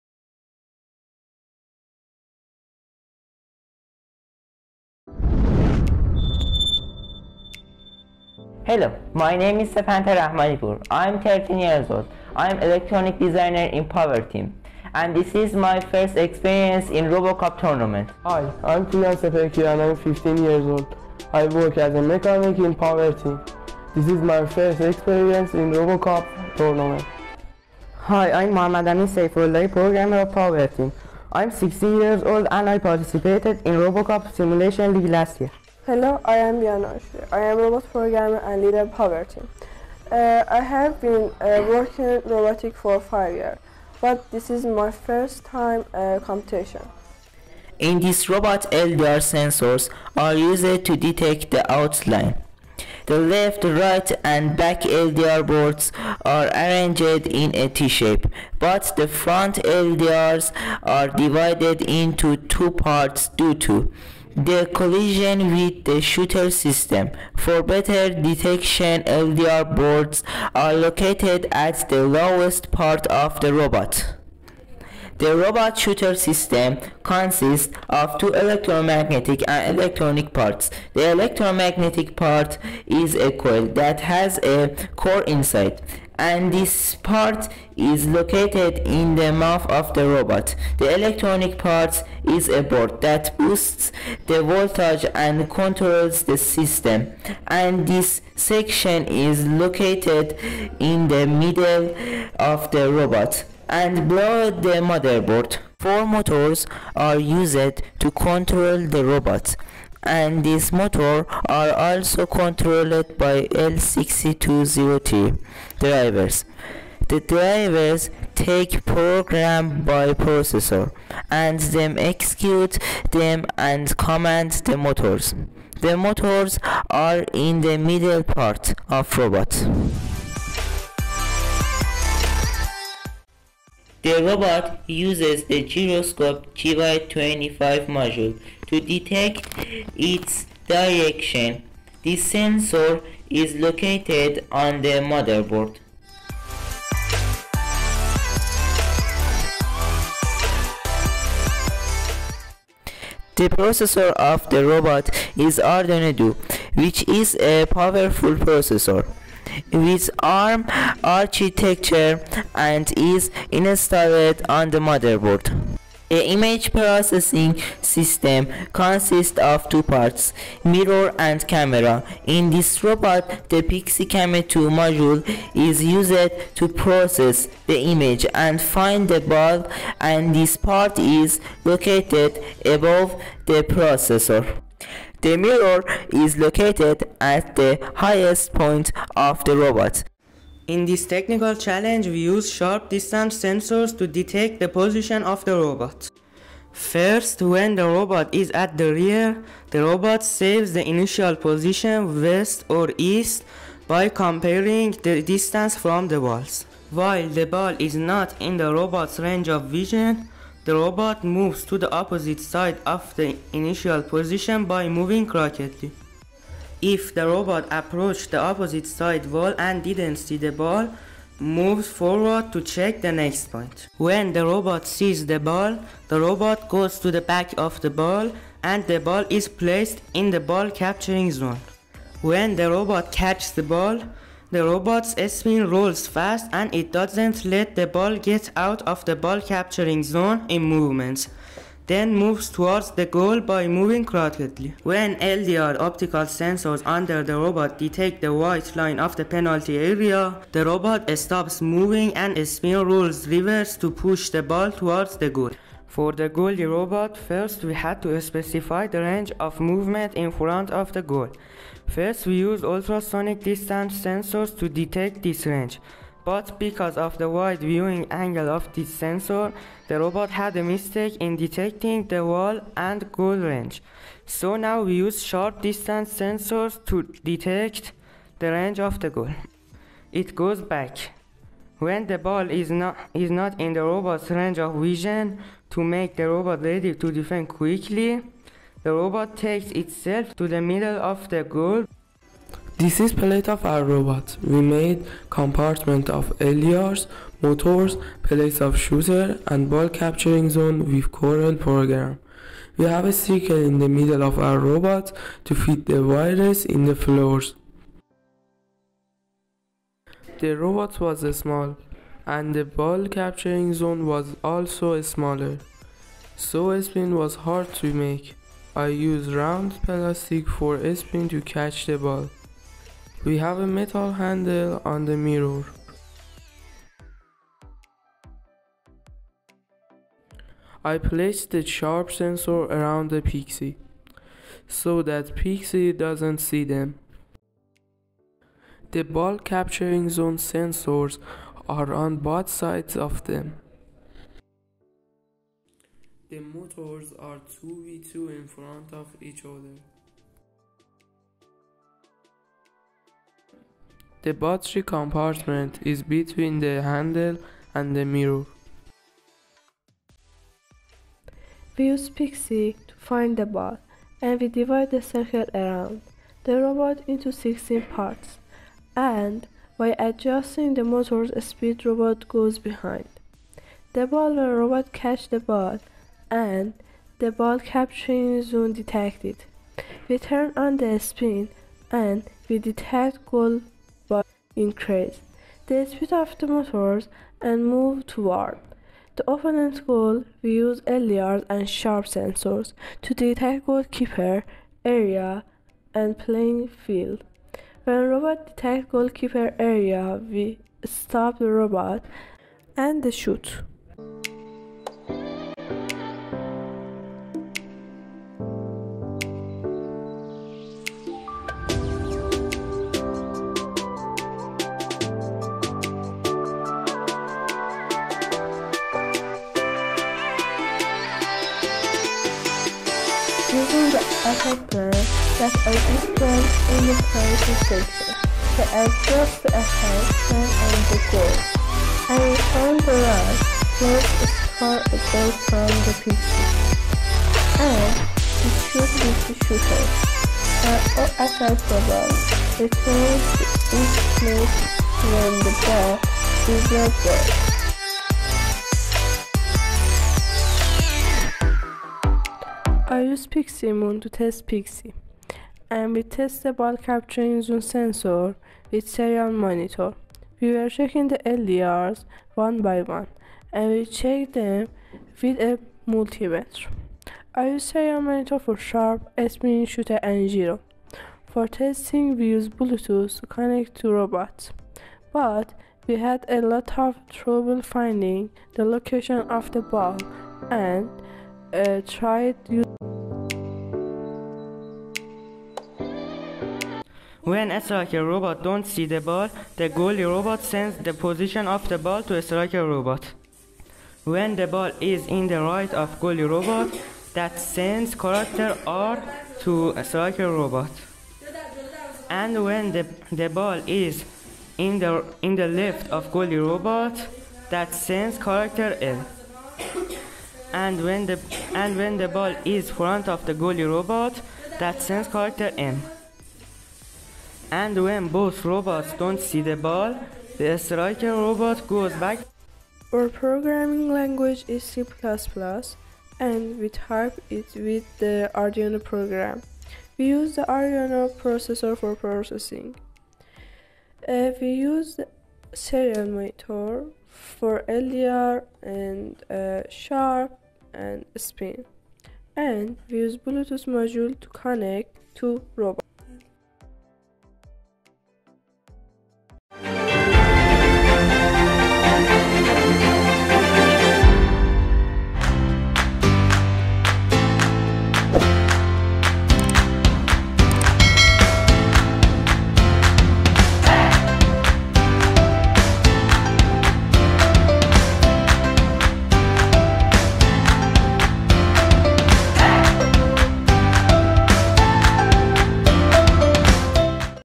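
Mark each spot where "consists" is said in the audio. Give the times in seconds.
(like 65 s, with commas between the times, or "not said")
77 s, 168 s.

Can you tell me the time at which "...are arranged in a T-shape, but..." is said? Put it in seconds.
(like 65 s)
56 s.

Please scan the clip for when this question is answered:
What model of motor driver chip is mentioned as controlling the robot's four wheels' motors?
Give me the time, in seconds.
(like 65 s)
113 s.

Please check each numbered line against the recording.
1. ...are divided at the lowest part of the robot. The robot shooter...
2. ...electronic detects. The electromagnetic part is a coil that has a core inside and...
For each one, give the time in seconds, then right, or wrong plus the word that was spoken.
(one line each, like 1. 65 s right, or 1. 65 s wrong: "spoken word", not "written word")
1. 70 s wrong: "located", not "divided"
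2. 79 s wrong: "parts", not "detects".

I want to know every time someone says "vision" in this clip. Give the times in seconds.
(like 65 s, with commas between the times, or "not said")
209 s, 284 s.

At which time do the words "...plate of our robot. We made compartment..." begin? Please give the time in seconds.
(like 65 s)
293 s.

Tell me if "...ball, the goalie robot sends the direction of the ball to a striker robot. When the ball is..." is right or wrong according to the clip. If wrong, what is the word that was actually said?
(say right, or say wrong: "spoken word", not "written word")
wrong: "position", not "direction".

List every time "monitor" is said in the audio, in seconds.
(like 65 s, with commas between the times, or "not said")
459 s, 468 s, 536 s.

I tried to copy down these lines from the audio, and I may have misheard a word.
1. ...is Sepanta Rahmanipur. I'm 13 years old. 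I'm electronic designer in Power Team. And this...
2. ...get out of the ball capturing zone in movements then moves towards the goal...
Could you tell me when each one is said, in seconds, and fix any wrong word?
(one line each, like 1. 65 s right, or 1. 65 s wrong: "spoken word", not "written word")
1. 9 s right
2. 238 s right.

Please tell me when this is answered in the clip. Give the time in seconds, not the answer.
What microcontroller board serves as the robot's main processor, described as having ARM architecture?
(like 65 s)
155 s.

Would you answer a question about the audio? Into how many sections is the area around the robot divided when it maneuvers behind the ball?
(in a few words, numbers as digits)
16.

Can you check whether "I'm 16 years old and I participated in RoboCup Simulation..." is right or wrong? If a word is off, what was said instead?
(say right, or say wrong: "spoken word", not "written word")
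right.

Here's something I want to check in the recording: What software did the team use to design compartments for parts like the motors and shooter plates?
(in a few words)
Corel.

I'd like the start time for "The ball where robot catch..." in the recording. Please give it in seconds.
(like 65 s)
373 s.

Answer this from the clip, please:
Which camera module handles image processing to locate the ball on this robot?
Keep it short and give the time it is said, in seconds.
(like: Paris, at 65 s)
PixyCam 2, at 173 s.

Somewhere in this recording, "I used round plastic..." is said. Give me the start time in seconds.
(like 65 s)
318 s.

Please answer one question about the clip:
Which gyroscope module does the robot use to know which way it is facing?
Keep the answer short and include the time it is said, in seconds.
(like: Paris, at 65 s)
GY25, at 136 s.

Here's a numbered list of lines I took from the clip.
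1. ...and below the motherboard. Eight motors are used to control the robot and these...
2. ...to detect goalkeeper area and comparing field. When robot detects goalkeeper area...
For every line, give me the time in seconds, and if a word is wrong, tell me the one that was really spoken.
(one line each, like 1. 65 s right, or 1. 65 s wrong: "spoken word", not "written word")
1. 103 s wrong: "Four", not "Eight"
2. 393 s wrong: "playing", not "comparing".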